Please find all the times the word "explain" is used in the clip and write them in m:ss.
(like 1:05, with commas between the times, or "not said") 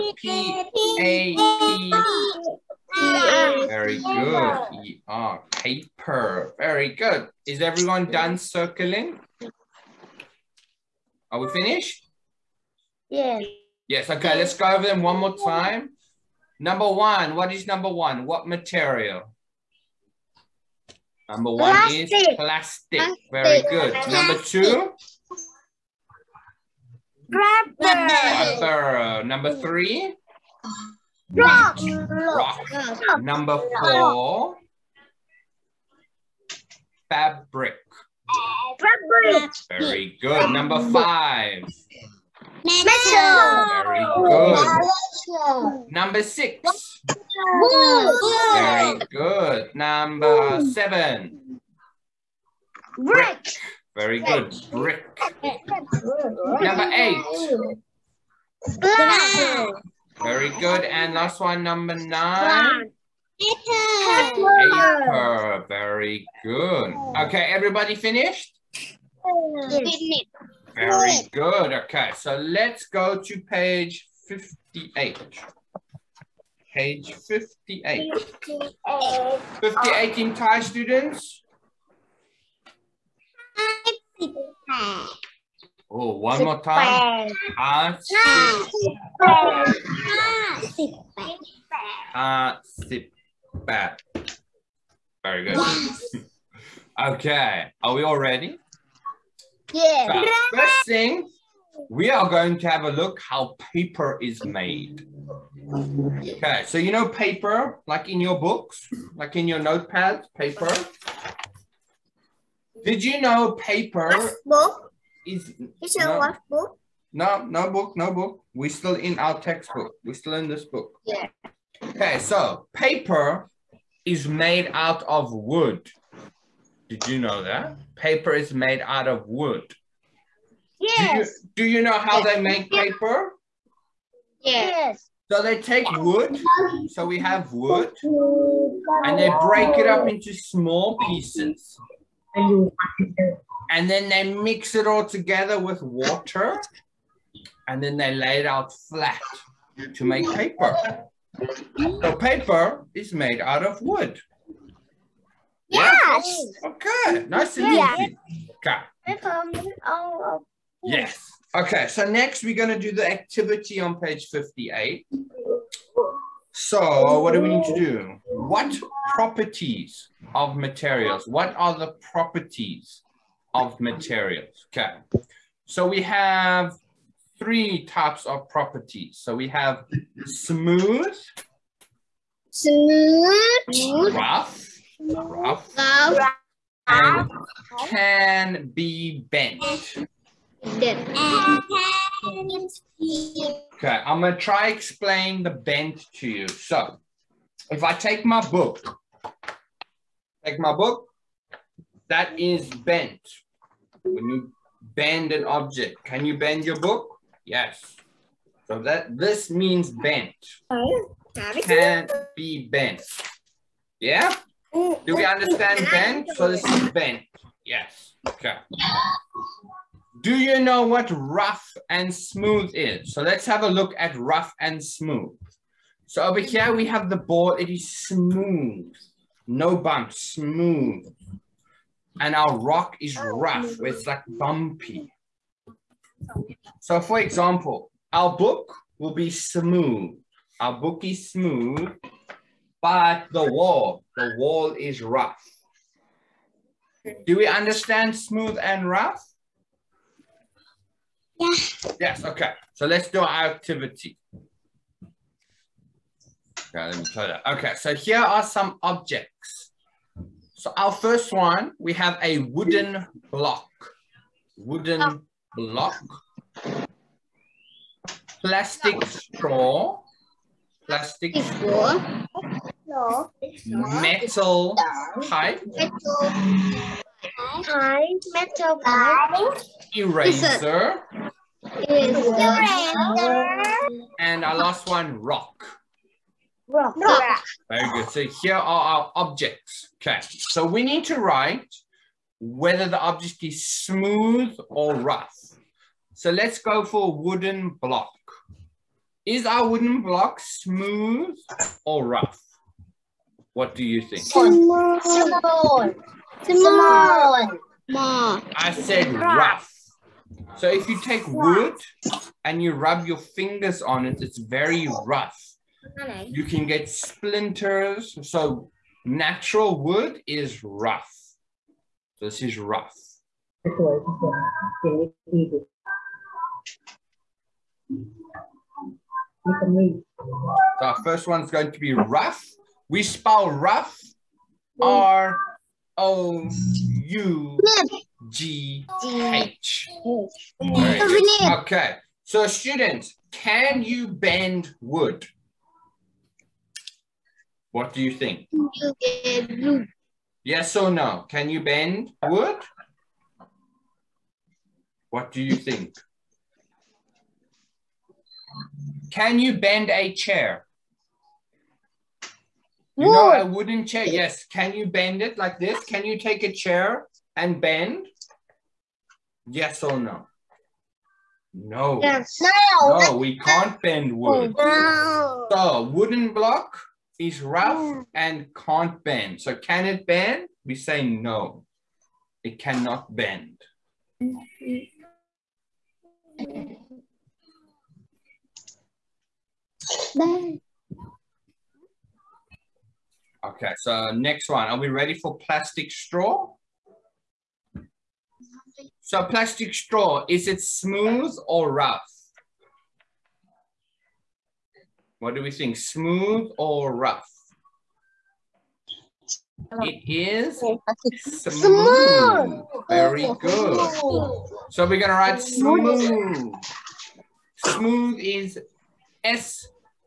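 3:14.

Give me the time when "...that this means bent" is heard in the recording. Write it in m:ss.
3:28.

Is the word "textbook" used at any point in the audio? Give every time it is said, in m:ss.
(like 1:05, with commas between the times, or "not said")
1:59.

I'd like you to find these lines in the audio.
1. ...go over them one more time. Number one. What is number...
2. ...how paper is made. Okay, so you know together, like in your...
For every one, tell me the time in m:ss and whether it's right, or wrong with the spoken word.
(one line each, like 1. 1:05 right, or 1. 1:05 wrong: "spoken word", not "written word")
1. 0:14 right
2. 1:43 wrong: "paper", not "together".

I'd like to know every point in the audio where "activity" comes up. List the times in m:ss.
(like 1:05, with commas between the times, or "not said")
2:43, 4:13.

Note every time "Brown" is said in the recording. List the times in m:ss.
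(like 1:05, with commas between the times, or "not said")
0:58.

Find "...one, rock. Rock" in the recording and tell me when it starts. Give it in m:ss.
4:44.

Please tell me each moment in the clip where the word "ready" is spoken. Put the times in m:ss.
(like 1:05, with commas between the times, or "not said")
1:38, 6:34.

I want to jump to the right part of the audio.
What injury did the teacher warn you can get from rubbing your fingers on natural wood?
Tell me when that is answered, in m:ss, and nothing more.
5:16.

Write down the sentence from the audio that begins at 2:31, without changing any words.
The paper is made out of wood.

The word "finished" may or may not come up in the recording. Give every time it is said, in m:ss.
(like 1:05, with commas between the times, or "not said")
0:11, 1:07.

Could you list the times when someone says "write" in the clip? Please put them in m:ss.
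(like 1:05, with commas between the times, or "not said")
4:51, 6:55.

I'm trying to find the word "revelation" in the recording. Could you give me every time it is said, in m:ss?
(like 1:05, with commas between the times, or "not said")
not said.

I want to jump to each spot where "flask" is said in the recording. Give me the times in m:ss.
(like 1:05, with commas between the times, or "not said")
not said.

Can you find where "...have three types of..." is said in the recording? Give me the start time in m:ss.
2:56.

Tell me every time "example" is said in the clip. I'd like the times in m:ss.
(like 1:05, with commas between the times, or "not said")
3:57.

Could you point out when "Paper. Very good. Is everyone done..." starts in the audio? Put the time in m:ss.
0:05.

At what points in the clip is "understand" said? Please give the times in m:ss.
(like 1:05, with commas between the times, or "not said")
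3:35, 4:07.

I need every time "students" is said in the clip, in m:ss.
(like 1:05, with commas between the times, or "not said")
1:20, 5:42.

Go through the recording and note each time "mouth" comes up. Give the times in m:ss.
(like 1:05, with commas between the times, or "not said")
not said.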